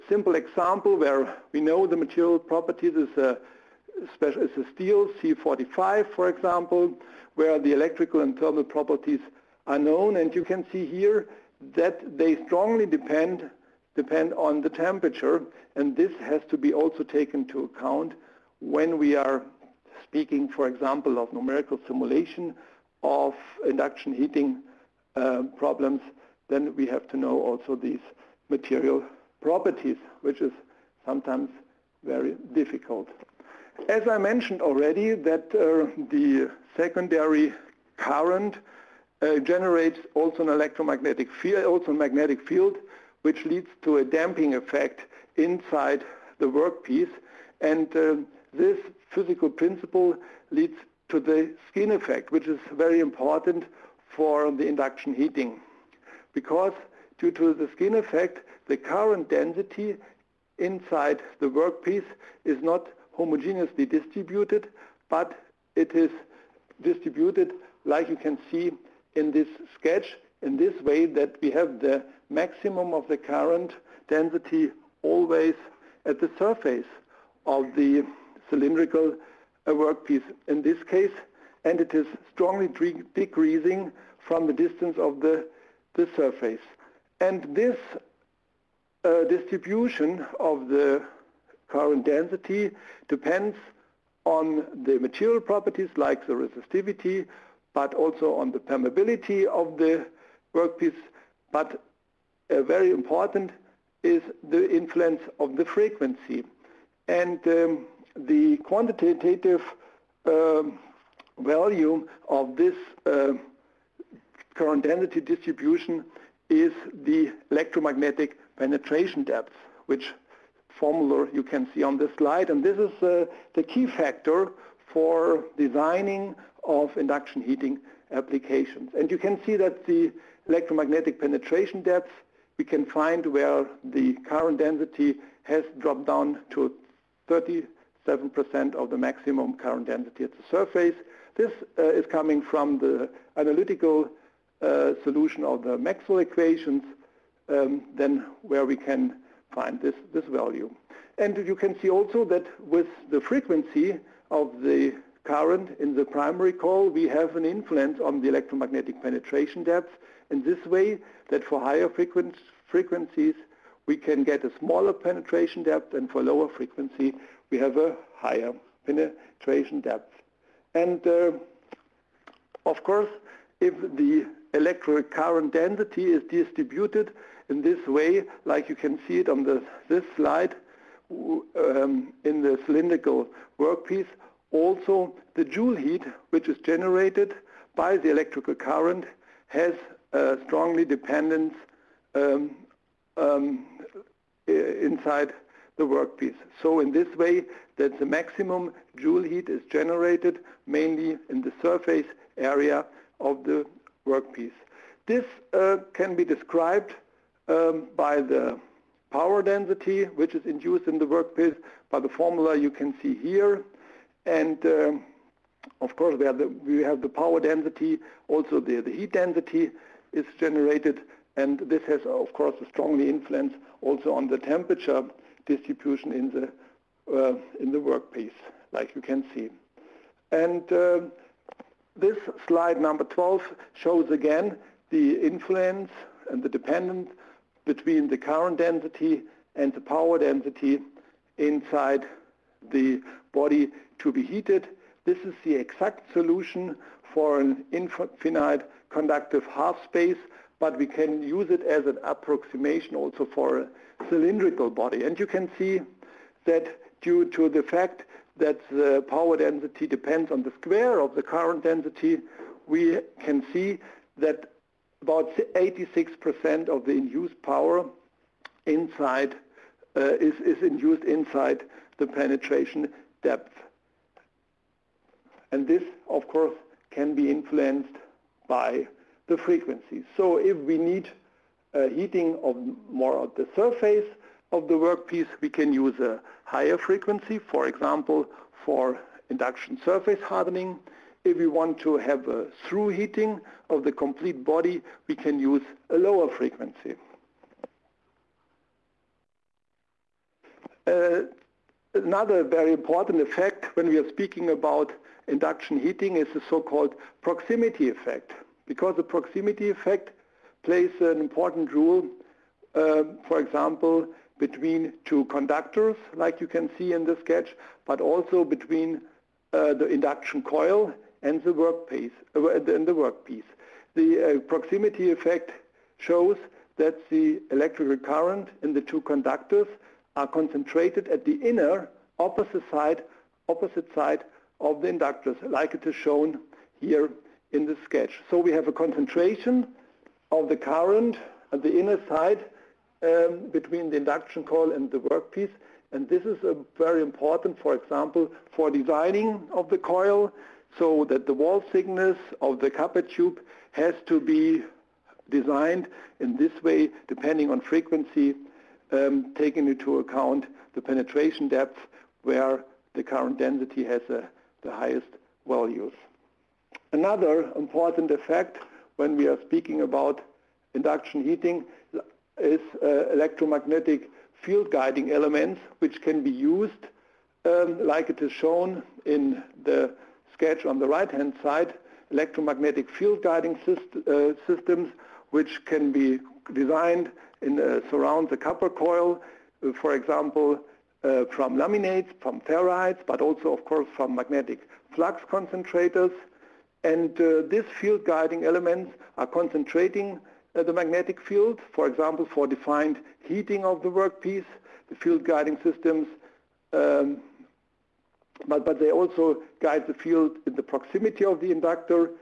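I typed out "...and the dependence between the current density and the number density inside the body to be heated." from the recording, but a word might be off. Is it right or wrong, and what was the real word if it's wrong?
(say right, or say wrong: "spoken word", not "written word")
wrong: "power", not "number".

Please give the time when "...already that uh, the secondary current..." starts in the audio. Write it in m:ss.
0:34.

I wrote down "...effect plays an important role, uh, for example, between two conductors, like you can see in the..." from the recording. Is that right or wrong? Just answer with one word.
right.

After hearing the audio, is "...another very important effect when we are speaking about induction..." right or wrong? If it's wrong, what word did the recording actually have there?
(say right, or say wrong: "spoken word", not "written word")
right.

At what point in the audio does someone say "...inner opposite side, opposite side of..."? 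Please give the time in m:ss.
5:31.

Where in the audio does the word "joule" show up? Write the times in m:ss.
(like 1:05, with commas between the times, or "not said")
3:05, 3:18.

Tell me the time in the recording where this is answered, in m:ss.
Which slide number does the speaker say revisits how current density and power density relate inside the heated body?
3:52.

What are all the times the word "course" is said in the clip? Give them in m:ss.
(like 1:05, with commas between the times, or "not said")
2:52, 3:35, 3:42, 4:36, 6:33.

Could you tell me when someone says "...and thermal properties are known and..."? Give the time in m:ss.
0:08.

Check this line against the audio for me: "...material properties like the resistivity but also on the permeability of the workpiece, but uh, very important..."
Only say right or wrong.
right.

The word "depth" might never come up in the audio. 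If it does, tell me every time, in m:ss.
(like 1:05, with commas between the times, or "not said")
1:59, 2:11, 2:39, 2:45, 2:49, 4:33, 6:01.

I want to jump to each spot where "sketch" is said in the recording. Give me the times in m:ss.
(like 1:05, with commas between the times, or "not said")
1:09, 5:17, 5:37, 6:20.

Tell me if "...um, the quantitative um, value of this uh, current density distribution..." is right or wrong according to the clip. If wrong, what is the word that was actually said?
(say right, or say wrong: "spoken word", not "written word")
right.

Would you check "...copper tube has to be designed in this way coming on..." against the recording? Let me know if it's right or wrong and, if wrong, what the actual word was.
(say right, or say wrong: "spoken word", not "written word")
wrong: "depending", not "coming".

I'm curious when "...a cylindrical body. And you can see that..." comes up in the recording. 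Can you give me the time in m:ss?
4:13.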